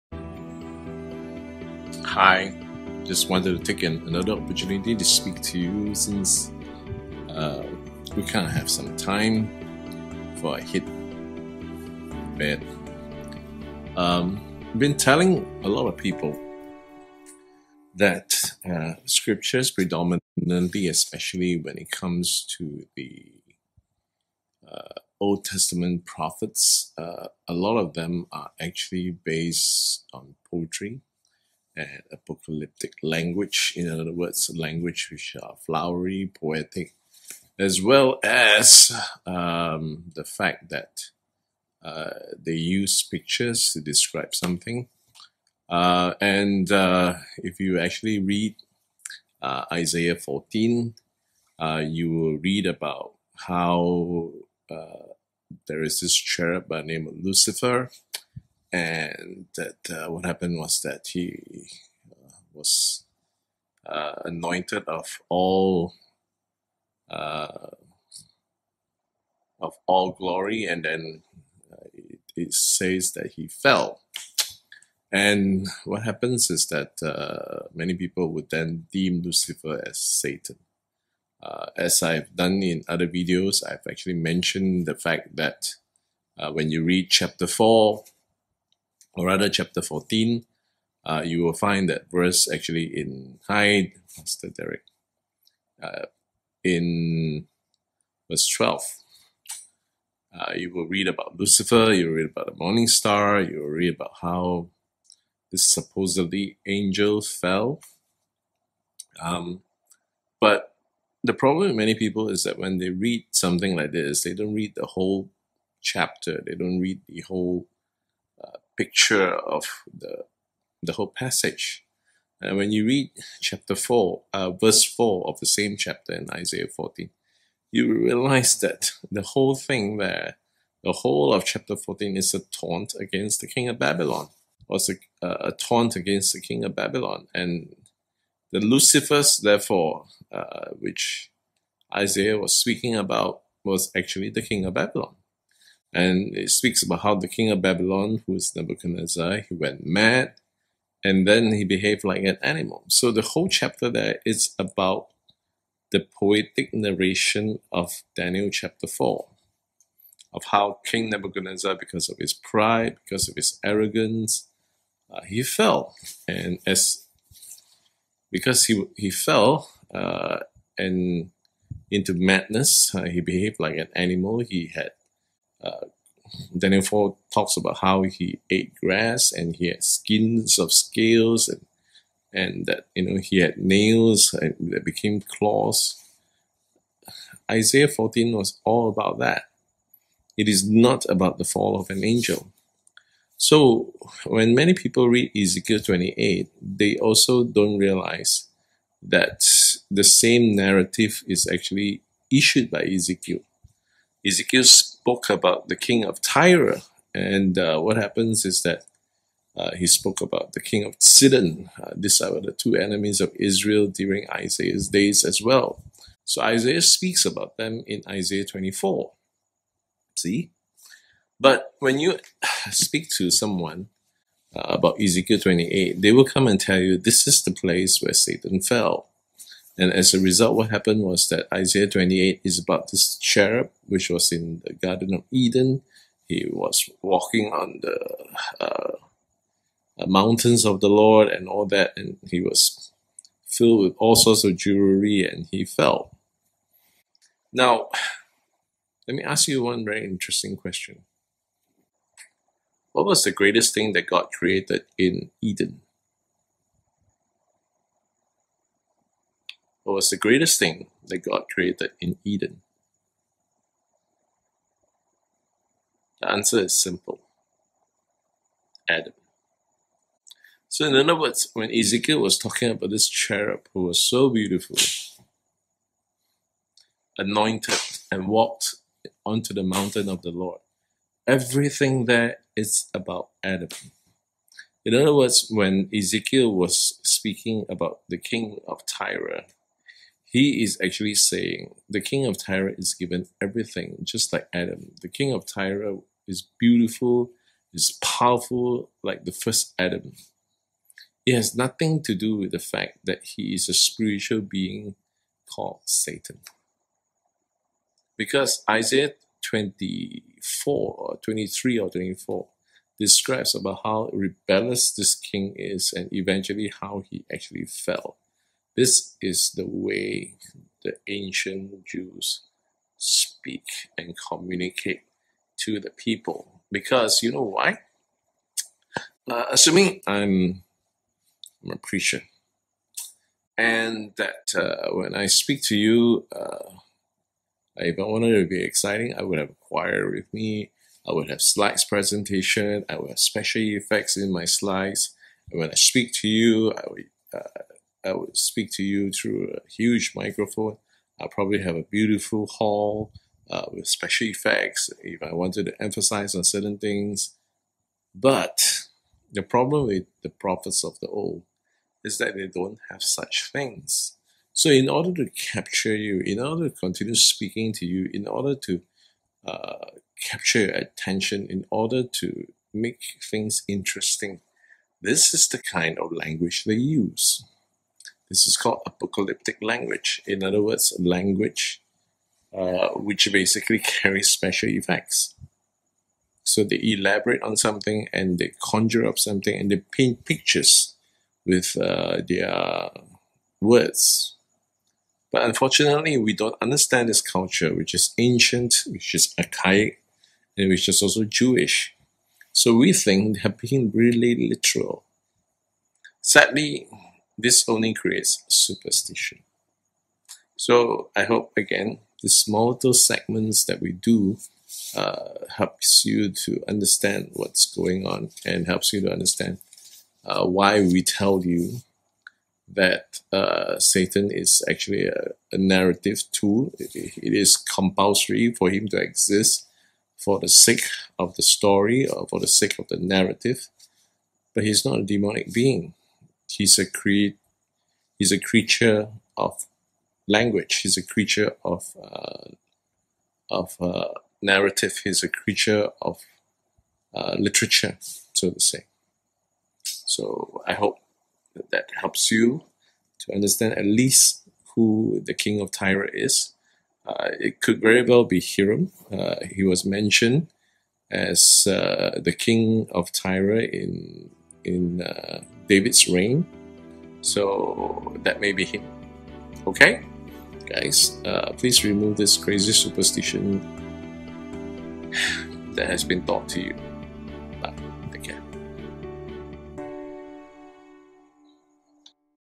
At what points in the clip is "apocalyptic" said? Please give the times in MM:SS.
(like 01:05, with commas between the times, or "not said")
00:32, 06:18.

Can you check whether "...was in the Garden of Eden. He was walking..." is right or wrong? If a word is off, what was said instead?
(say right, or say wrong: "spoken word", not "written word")
right.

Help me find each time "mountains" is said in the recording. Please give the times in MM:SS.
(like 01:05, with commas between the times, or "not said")
04:00, 04:39.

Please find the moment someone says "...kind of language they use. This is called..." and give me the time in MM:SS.
06:15.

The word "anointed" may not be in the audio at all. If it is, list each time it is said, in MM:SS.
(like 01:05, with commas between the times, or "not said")
01:04, 04:37.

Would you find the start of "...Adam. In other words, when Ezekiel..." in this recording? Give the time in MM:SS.
04:43.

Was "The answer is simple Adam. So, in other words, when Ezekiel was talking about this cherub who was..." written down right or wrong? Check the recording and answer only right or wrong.
right.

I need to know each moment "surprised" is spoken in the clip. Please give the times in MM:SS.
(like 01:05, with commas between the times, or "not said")
not said.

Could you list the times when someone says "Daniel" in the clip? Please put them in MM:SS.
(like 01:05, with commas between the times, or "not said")
02:38, 02:56.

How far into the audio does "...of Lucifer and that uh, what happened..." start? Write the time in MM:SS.
00:57.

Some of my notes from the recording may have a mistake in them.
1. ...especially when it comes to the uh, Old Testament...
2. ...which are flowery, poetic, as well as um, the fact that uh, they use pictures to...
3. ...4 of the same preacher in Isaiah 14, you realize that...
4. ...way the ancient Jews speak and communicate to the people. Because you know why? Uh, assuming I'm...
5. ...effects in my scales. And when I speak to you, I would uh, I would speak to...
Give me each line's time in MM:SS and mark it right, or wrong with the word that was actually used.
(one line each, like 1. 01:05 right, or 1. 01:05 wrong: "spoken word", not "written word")
1. 00:20 right
2. 00:35 right
3. 02:04 wrong: "chapter", not "preacher"
4. 05:19 right
5. 05:43 wrong: "slides", not "scales".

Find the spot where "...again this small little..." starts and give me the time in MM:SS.
06:51.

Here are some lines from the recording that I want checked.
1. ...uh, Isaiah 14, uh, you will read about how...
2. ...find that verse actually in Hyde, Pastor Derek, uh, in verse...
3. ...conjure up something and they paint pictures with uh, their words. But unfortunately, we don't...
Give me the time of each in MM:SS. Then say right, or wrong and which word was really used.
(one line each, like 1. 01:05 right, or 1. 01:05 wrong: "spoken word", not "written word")
1. 00:49 right
2. 01:31 right
3. 06:28 right.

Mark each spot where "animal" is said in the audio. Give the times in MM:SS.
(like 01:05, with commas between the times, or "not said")
02:32, 02:53.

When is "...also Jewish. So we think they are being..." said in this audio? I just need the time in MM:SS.
06:41.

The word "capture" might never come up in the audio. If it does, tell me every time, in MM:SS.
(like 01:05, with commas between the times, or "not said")
06:05, 06:10.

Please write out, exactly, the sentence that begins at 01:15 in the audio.
And what happens is that uh, many people would then deem Lucifer as Satan.